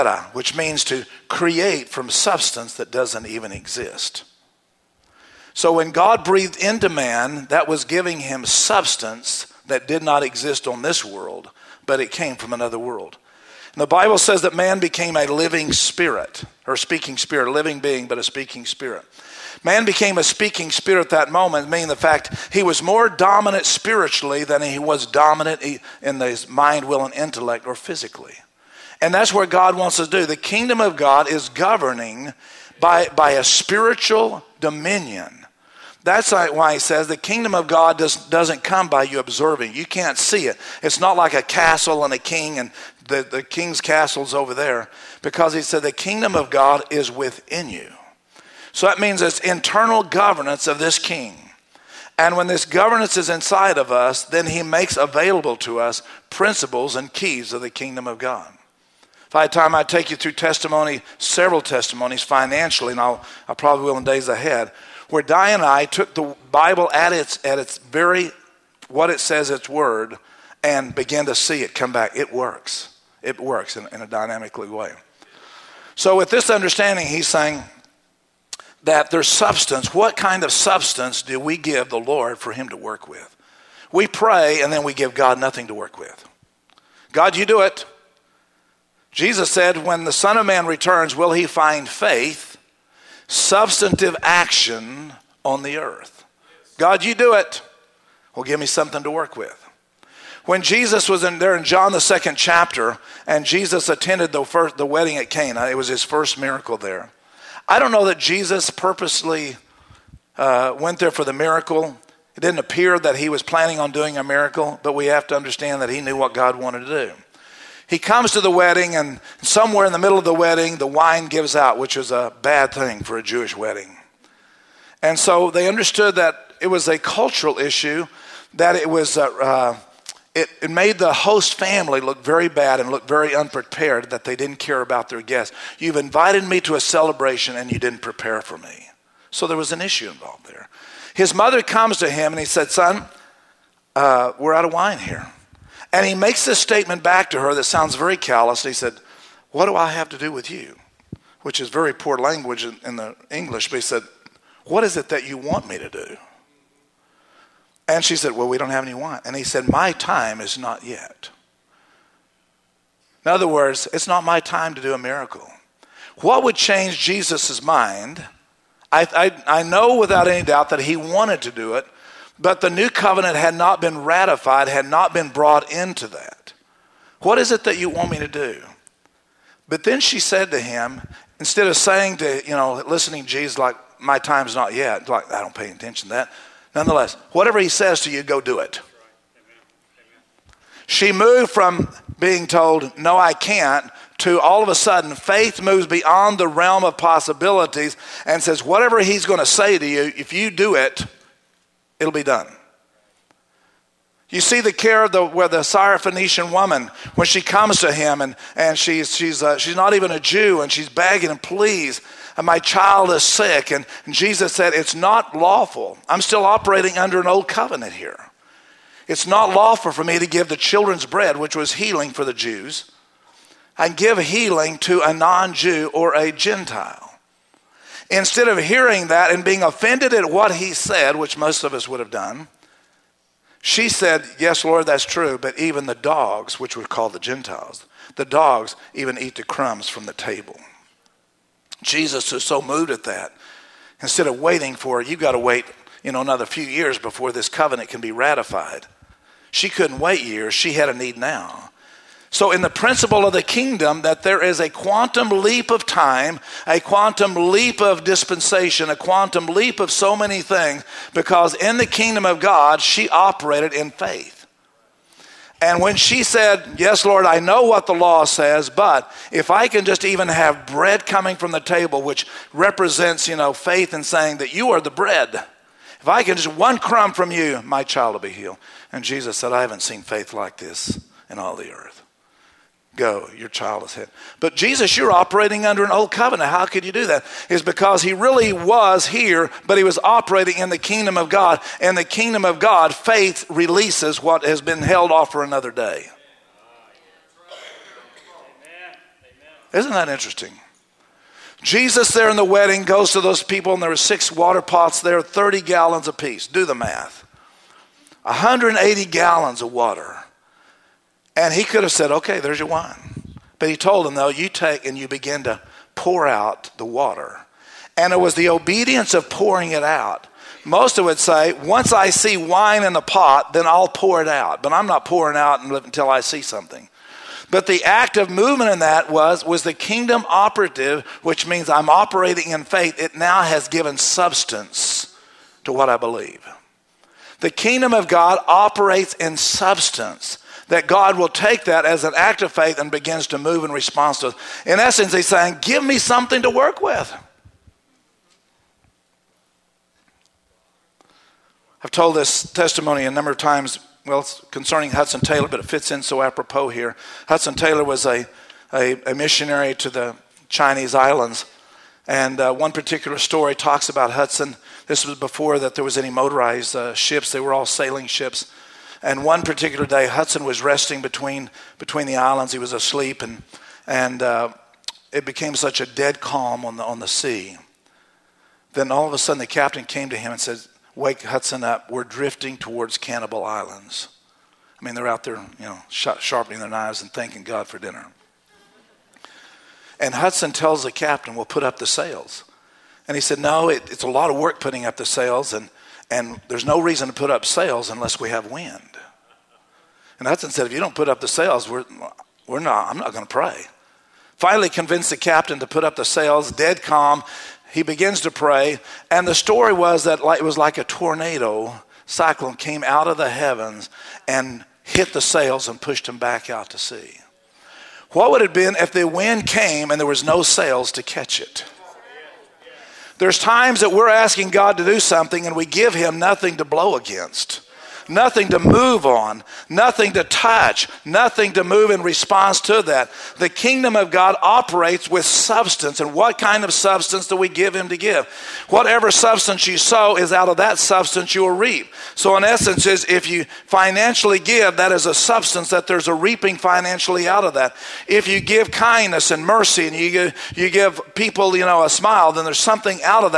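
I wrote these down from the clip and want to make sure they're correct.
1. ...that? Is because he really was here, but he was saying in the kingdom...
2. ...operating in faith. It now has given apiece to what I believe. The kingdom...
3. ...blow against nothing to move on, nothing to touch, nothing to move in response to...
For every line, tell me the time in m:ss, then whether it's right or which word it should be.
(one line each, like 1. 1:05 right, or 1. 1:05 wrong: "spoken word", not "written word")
1. 4:47 wrong: "operating", not "saying"
2. 5:31 wrong: "substance", not "apiece"
3. 7:06 right.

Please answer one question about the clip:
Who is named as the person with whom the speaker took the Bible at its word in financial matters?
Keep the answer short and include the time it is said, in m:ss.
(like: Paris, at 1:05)
Diane, at 1:05.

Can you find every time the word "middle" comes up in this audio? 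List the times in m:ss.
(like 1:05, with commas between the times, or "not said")
1:59.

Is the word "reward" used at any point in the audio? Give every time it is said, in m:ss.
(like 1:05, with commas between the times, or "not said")
not said.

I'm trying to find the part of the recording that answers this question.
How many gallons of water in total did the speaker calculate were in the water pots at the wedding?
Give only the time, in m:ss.
5:08.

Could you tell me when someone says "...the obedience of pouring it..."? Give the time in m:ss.
5:18.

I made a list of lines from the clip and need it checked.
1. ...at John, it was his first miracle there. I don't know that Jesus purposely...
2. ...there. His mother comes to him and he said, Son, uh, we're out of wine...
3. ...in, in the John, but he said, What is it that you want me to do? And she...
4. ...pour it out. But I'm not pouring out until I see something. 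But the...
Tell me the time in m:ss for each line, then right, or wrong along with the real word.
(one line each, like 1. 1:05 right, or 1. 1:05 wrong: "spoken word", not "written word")
1. 1:45 wrong: "Cana", not "John"
2. 2:20 right
3. 2:32 wrong: "English", not "John"
4. 5:23 right.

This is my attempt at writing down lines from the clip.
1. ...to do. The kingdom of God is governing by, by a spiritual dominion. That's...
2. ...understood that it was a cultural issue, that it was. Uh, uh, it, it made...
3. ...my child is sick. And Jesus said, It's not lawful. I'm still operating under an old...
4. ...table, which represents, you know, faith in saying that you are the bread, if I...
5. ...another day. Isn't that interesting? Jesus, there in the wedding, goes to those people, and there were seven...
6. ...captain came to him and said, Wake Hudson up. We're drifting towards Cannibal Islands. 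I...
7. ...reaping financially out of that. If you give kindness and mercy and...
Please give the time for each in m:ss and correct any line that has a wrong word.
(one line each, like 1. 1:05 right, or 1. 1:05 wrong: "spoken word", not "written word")
1. 0:30 right
2. 2:05 right
3. 3:32 right
4. 4:31 right
5. 4:55 wrong: "six", not "seven"
6. 6:19 right
7. 7:26 right.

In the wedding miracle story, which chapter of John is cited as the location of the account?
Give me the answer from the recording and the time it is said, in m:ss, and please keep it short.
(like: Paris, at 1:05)
Second chapter, at 1:41.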